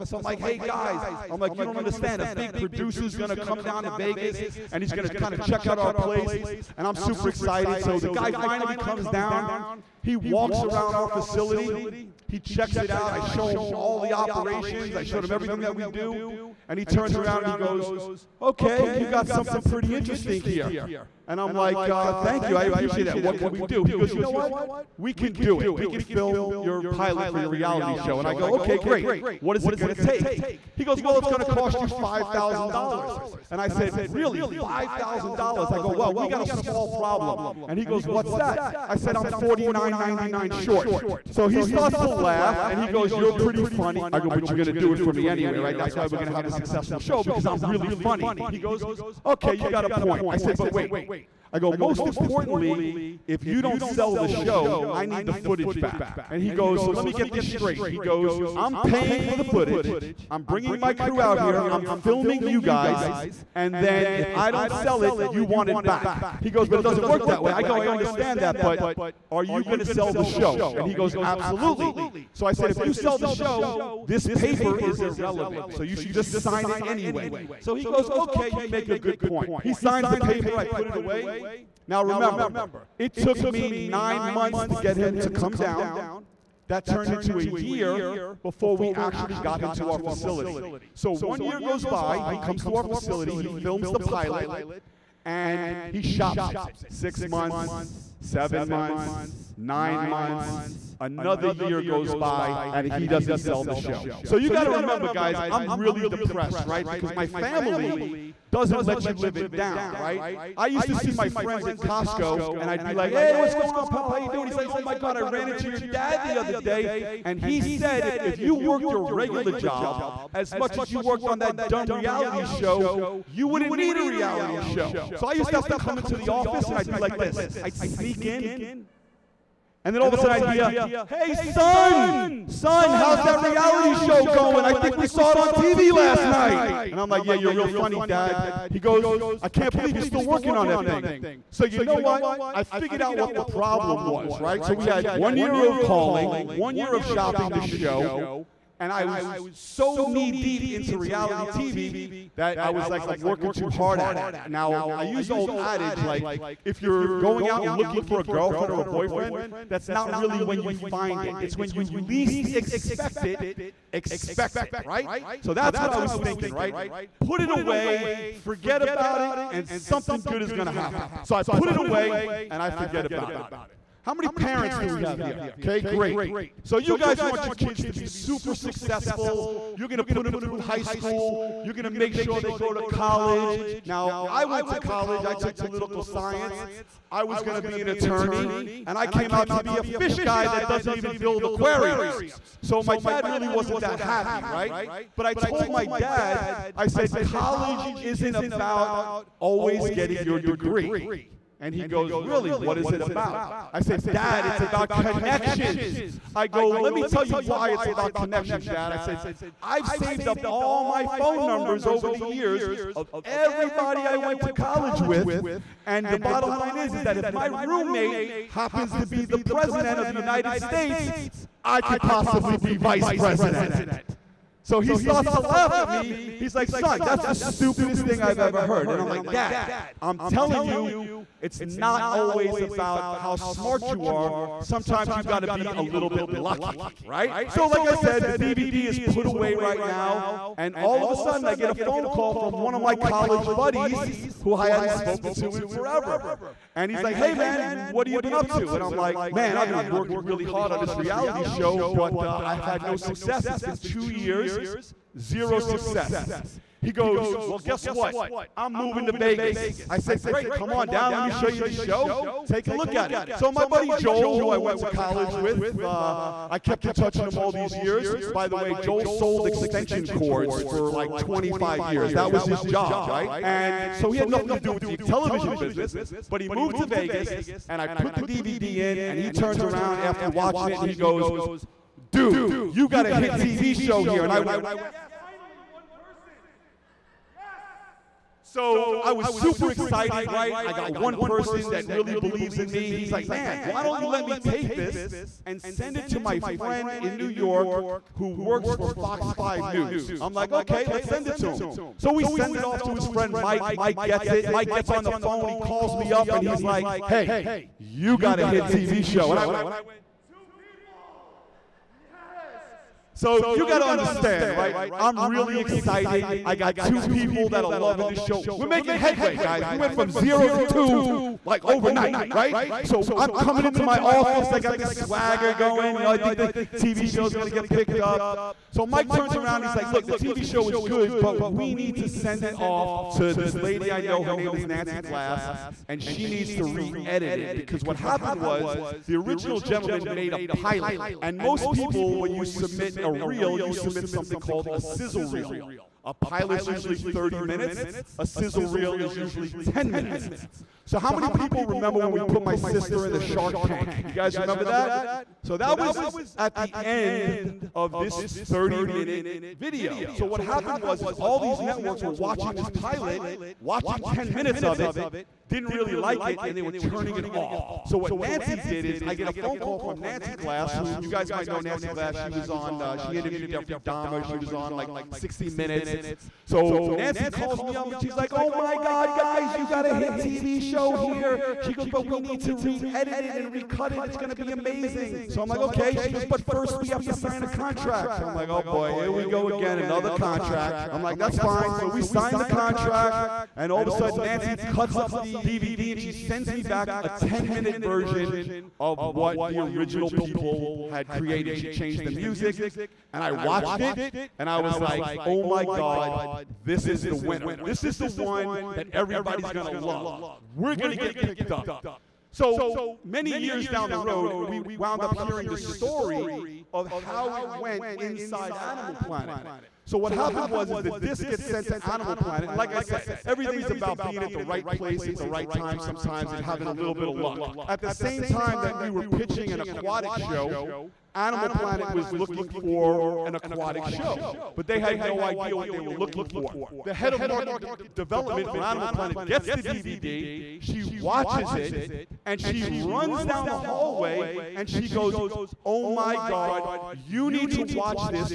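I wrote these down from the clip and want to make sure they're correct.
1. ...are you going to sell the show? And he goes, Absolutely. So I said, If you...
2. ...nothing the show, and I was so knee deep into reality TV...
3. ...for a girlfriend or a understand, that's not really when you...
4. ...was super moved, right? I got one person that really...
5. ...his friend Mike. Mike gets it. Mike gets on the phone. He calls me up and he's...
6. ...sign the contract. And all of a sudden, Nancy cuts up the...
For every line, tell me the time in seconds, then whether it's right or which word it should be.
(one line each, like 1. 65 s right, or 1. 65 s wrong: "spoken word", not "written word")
1. 69 s right
2. 147 s wrong: "shopping", not "nothing"
3. 158 s wrong: "boyfriend", not "understand"
4. 289 s wrong: "excited", not "moved"
5. 302 s right
6. 392 s right.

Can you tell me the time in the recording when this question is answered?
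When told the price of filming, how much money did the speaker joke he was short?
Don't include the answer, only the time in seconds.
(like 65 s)
39 s.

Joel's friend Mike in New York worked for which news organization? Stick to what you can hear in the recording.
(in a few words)
Fox 5 News.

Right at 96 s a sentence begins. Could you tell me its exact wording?
Six months, seven months, nine months, another year goes by and he doesn't sell the show.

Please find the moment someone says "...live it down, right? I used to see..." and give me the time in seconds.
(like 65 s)
109 s.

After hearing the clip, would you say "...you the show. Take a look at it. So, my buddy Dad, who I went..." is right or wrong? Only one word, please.
wrong.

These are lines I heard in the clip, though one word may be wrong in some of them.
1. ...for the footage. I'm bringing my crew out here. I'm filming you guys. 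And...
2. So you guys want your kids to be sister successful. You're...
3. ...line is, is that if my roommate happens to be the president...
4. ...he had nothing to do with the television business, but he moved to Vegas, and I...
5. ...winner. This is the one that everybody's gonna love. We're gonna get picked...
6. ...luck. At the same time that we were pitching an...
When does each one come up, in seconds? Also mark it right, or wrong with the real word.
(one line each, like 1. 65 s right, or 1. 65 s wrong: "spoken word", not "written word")
1. 59 s right
2. 176 s wrong: "super", not "sister"
3. 216 s right
4. 274 s right
5. 407 s right
6. 427 s right.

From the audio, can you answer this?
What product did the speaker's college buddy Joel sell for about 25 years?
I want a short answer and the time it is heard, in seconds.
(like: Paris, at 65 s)
Extension cords, at 269 s.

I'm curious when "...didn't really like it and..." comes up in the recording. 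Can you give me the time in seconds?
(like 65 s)
365 s.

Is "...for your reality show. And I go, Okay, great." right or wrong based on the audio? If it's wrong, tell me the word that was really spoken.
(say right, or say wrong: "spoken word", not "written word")
right.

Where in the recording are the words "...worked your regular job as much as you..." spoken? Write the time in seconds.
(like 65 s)
118 s.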